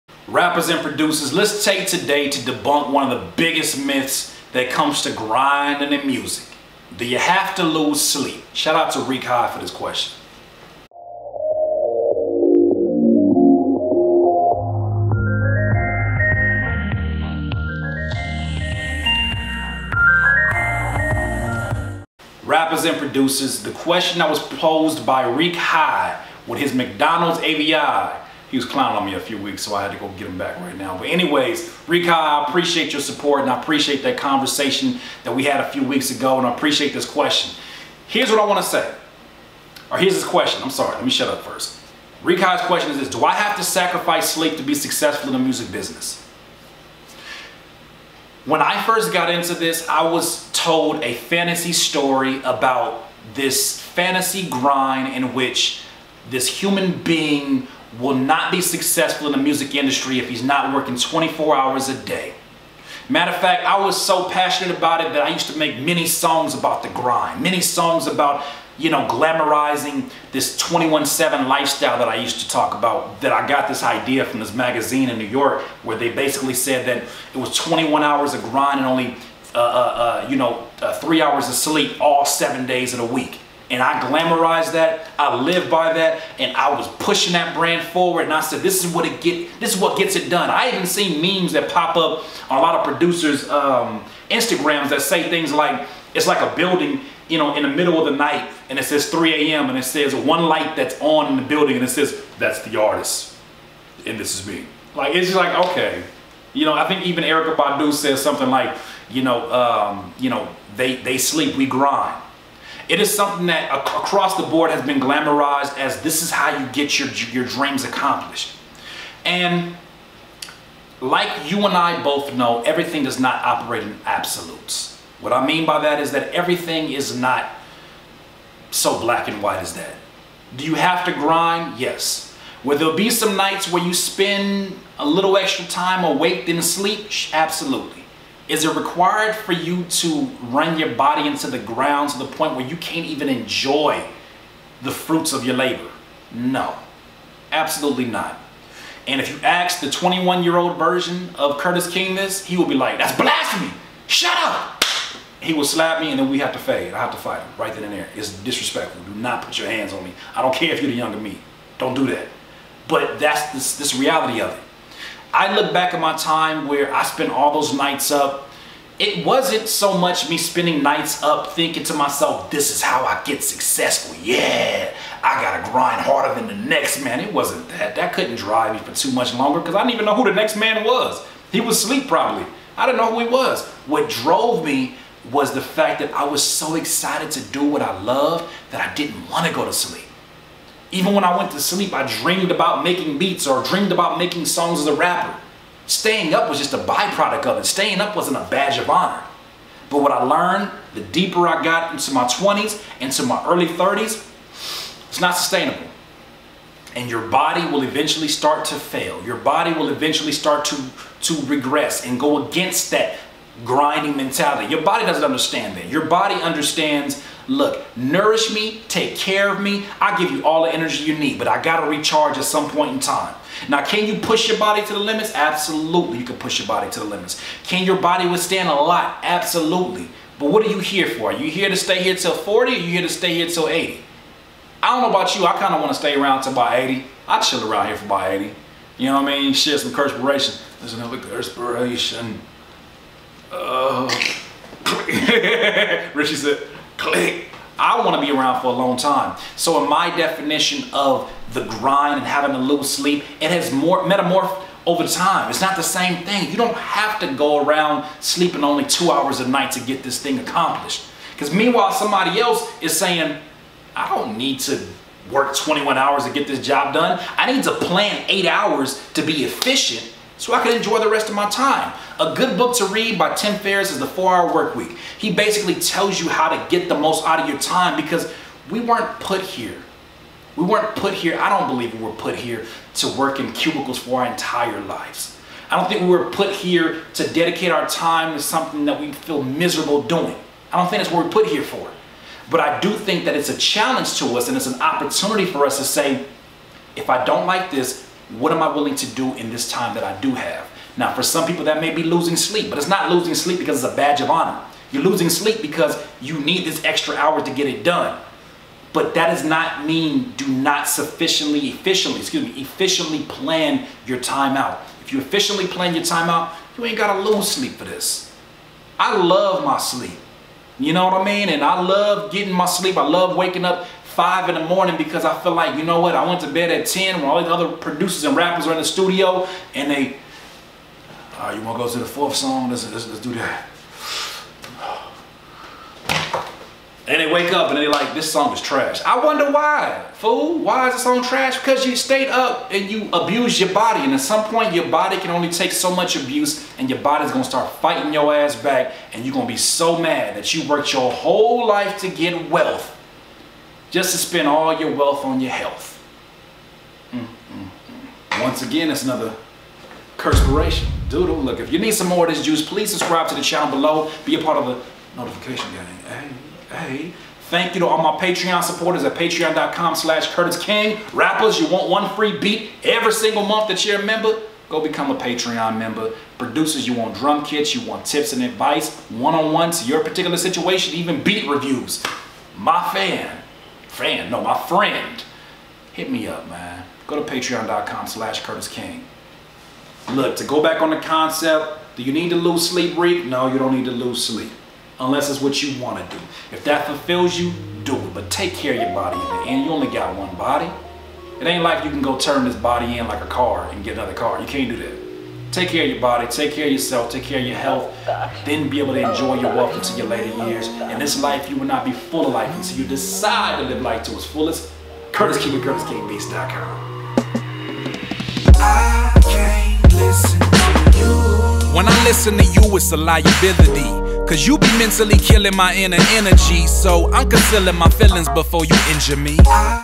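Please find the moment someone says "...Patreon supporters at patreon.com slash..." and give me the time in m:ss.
6:08.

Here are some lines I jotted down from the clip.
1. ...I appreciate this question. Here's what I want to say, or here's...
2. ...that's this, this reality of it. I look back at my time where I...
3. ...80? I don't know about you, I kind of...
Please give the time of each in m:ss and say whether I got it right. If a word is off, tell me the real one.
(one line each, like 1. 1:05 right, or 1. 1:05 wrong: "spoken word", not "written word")
1. 0:36 right
2. 2:43 right
3. 3:53 right.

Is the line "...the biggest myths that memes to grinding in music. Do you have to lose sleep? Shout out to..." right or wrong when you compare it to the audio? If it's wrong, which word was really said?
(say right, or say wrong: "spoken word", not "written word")
wrong: "comes", not "memes".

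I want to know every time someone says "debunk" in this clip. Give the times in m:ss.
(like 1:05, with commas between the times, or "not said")
0:02.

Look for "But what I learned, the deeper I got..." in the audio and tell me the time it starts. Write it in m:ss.
3:19.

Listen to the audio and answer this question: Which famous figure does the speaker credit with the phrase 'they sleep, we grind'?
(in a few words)
Erykah Badu.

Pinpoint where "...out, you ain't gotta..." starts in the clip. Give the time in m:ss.
5:16.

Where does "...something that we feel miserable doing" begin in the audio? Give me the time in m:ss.
4:48.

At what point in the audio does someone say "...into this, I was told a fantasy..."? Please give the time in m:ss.
0:49.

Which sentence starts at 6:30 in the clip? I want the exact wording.
Look, to go back on the concept, do you need to lose sleep, Reek?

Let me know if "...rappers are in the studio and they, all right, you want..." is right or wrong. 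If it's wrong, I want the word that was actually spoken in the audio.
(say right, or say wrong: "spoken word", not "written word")
right.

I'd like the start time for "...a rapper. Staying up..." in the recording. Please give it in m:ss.
3:14.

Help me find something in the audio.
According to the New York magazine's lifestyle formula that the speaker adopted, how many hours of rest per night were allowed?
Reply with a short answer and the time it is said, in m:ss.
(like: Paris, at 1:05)
3 hours, at 1:20.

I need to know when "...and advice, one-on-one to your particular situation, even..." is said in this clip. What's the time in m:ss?
6:18.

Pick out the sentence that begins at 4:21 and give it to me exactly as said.
Because meanwhile, somebody else is saying, I don't need to work 21 hours to get this job done.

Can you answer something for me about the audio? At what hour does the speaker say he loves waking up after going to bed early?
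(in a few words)
5 in the morning.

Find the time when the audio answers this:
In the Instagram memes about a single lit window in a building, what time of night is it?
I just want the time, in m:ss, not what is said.
1:39.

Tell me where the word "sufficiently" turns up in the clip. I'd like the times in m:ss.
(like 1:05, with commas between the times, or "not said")
5:10.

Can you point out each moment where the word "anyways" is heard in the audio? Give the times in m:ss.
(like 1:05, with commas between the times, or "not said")
0:31.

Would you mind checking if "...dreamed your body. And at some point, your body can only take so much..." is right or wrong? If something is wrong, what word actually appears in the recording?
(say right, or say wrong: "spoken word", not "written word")
wrong: "abused", not "dreamed".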